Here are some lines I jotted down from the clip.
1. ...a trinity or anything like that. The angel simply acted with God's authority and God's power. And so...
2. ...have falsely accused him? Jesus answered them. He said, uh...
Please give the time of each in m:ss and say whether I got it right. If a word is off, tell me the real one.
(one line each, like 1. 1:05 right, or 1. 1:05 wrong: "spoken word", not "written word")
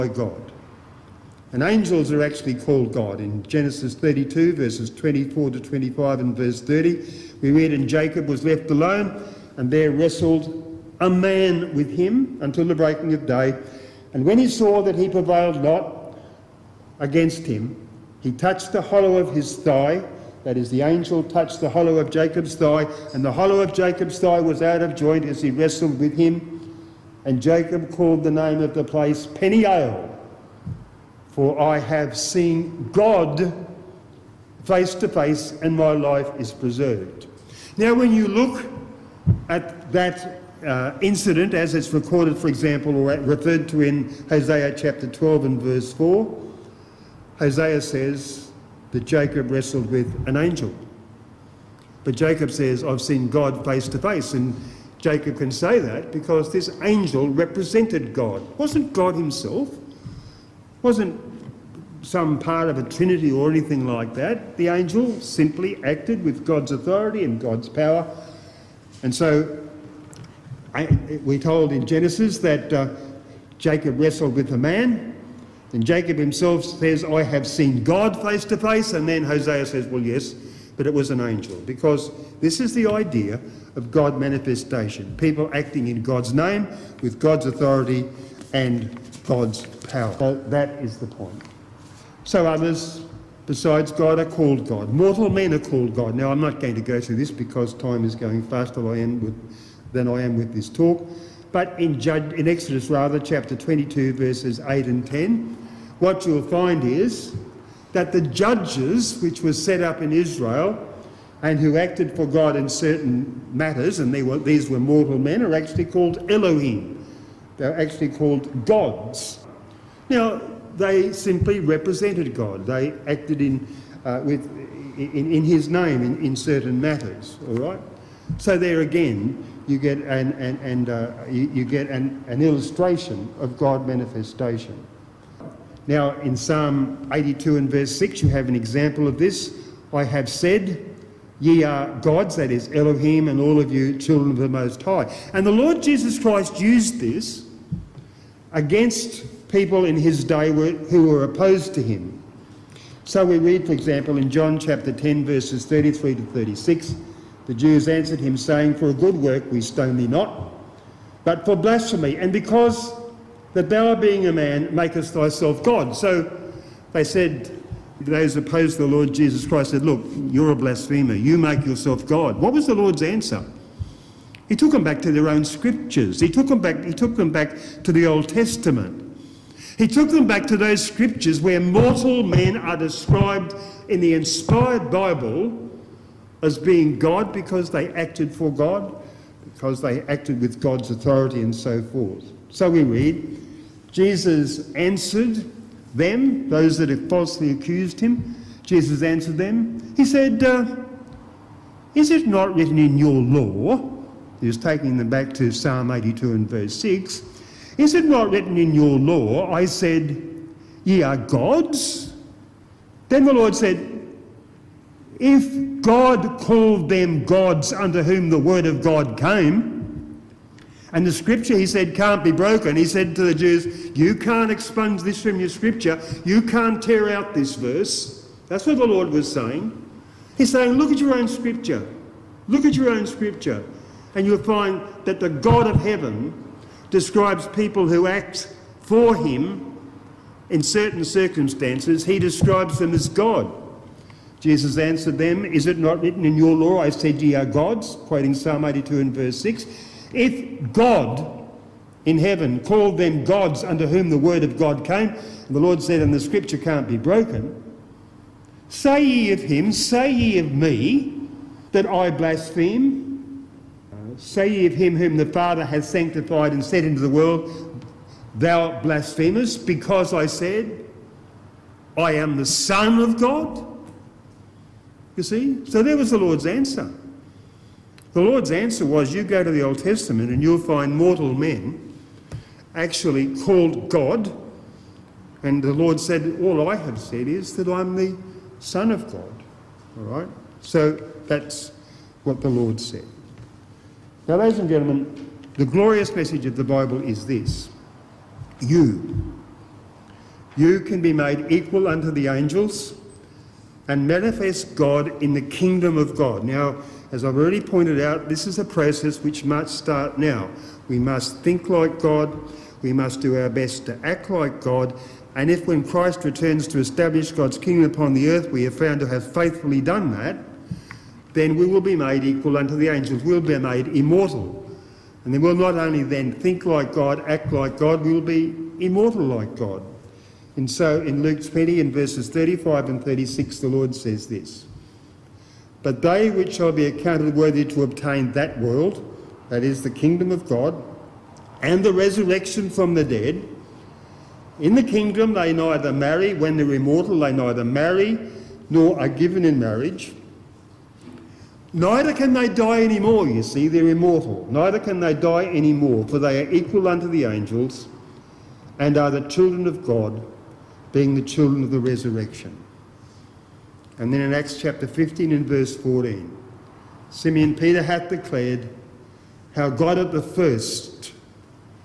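1. 1:02 right
2. 3:16 right.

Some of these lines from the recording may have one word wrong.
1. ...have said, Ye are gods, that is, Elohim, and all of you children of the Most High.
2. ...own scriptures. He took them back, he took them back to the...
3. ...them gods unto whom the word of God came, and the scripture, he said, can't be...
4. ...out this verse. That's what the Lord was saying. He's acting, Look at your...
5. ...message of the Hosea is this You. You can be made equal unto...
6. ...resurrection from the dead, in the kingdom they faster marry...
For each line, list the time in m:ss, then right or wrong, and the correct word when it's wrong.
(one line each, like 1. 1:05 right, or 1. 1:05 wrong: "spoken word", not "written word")
1. 2:20 right
2. 2:55 right
3. 3:36 right
4. 3:47 wrong: "saying", not "acting"
5. 4:56 wrong: "Bible", not "Hosea"
6. 5:41 wrong: "neither", not "faster".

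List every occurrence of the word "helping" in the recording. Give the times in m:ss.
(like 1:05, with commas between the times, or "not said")
not said.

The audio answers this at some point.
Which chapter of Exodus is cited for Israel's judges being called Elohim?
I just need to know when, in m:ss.
1:43.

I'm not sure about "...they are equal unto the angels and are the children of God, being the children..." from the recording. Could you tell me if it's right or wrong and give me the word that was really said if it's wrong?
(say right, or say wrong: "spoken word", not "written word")
right.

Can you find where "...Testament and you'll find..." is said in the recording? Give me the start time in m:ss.
4:39.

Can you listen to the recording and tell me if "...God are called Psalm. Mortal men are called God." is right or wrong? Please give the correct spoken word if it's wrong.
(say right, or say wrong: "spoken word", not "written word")
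wrong: "God", not "Psalm".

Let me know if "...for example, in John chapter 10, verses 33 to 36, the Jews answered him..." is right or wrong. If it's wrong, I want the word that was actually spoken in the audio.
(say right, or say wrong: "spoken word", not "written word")
right.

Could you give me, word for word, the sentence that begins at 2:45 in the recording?
So they said, those opposed to the Lord Jesus Christ said, Look, you're a blasphemer.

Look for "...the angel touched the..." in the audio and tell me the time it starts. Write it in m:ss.
0:20.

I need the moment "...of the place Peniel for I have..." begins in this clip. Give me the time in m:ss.
0:28.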